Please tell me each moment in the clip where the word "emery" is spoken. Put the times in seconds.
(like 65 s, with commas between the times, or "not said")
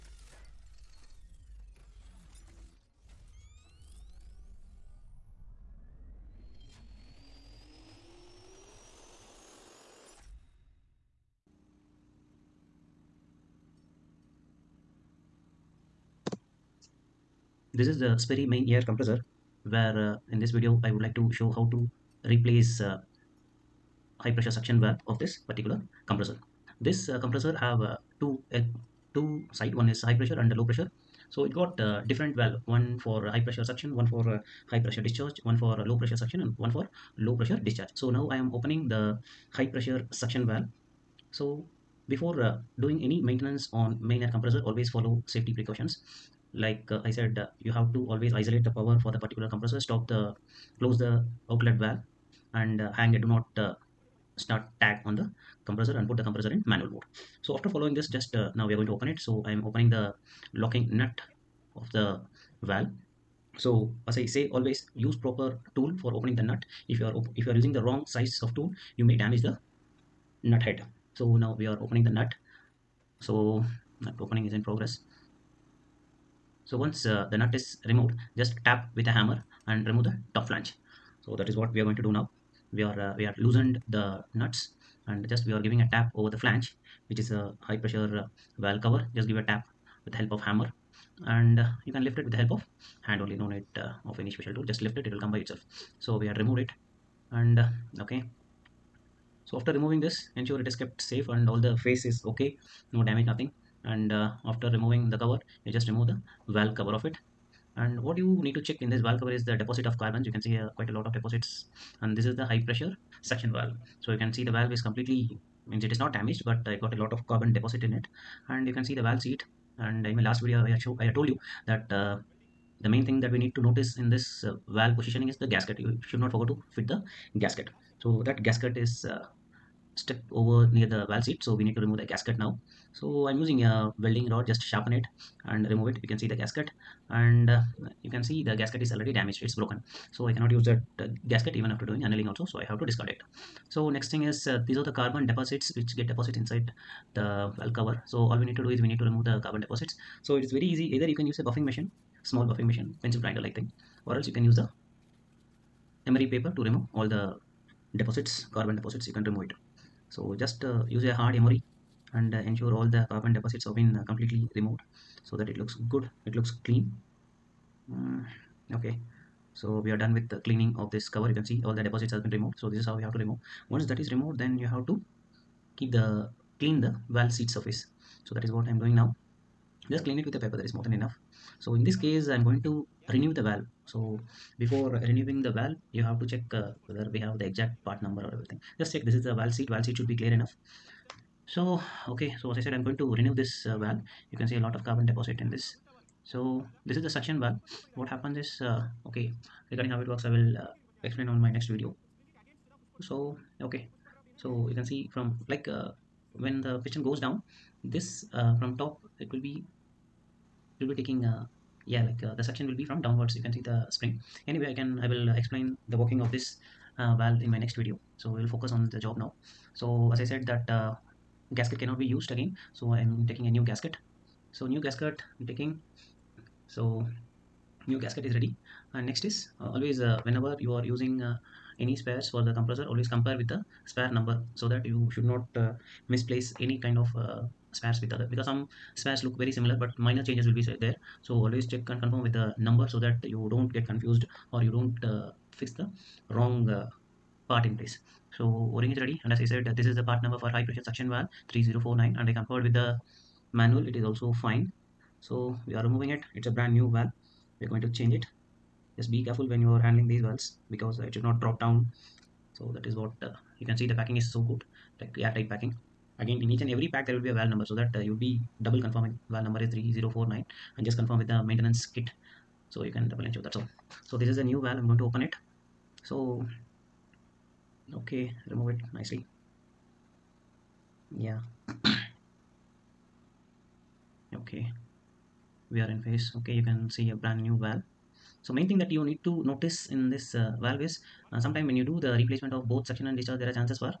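156 s, 161 s.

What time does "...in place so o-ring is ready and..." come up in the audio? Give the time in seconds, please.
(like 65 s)
247 s.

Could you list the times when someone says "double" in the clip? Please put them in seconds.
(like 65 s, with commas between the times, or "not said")
268 s, 273 s.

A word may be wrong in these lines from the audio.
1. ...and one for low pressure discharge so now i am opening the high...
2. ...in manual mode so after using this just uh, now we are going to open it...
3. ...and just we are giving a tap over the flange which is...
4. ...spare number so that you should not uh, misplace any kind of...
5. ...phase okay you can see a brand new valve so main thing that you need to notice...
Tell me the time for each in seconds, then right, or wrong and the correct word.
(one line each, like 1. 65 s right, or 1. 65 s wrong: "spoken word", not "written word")
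1. 36 s right
2. 56 s wrong: "following", not "using"
3. 85 s right
4. 233 s right
5. 286 s right.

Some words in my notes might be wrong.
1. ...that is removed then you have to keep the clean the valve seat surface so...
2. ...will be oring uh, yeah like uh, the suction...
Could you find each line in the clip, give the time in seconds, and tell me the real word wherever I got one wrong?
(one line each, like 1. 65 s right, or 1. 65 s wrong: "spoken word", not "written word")
1. 173 s right
2. 210 s wrong: "taking", not "oring".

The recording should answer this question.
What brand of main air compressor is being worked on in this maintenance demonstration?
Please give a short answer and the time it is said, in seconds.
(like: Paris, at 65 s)
Sperre, at 18 s.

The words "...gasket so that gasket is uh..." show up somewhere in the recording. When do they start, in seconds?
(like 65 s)
127 s.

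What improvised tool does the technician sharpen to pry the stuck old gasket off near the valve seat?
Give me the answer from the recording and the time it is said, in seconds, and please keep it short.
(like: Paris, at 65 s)
welding rod, at 133 s.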